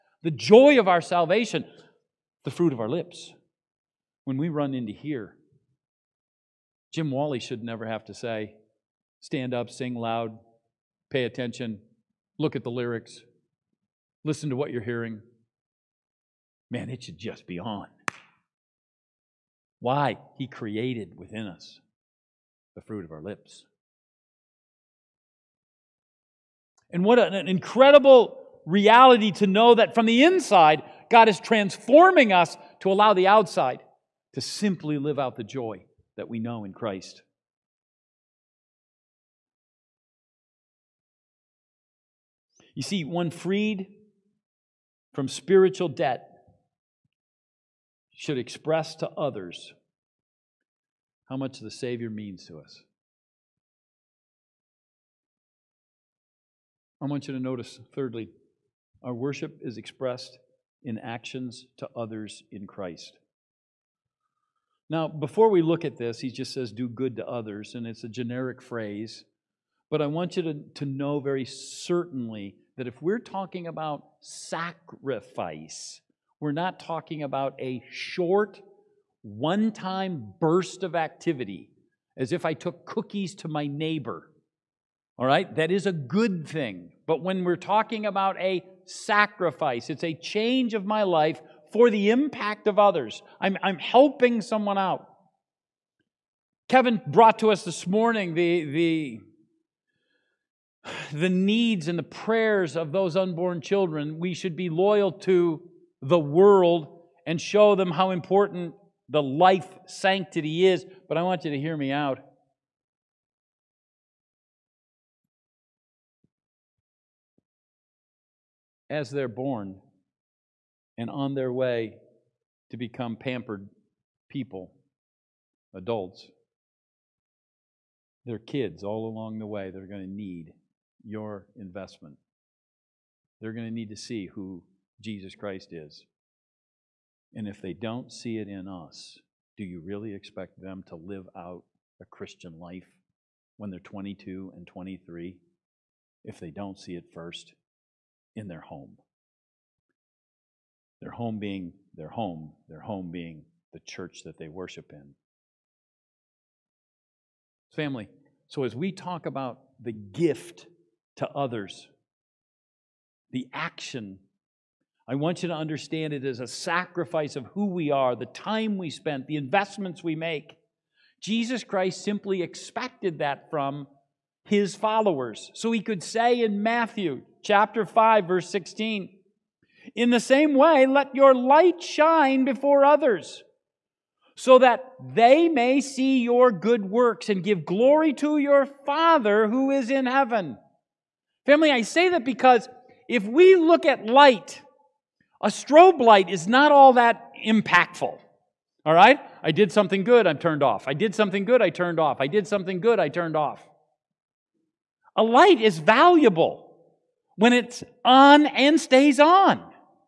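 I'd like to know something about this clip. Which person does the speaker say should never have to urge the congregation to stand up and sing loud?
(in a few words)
Jim Wally.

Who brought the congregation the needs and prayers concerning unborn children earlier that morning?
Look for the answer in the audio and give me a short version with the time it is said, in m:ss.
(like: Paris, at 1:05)
Kevin, at 1:36.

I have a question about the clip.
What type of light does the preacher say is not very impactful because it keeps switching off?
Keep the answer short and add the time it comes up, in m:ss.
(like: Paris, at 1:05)
strobe light, at 3:15.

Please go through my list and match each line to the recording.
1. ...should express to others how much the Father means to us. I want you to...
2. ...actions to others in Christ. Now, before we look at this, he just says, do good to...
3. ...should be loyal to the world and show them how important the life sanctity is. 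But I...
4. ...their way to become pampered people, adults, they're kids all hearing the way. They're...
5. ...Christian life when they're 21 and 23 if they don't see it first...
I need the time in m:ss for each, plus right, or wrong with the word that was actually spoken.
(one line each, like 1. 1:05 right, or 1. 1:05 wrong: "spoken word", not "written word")
1. 0:48 wrong: "Savior", not "Father"
2. 1:00 right
3. 1:44 right
4. 2:01 wrong: "along", not "hearing"
5. 2:22 wrong: "22", not "21".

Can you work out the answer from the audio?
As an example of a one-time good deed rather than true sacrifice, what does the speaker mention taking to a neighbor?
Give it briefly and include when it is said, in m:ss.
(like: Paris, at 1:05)
cookies, at 1:22.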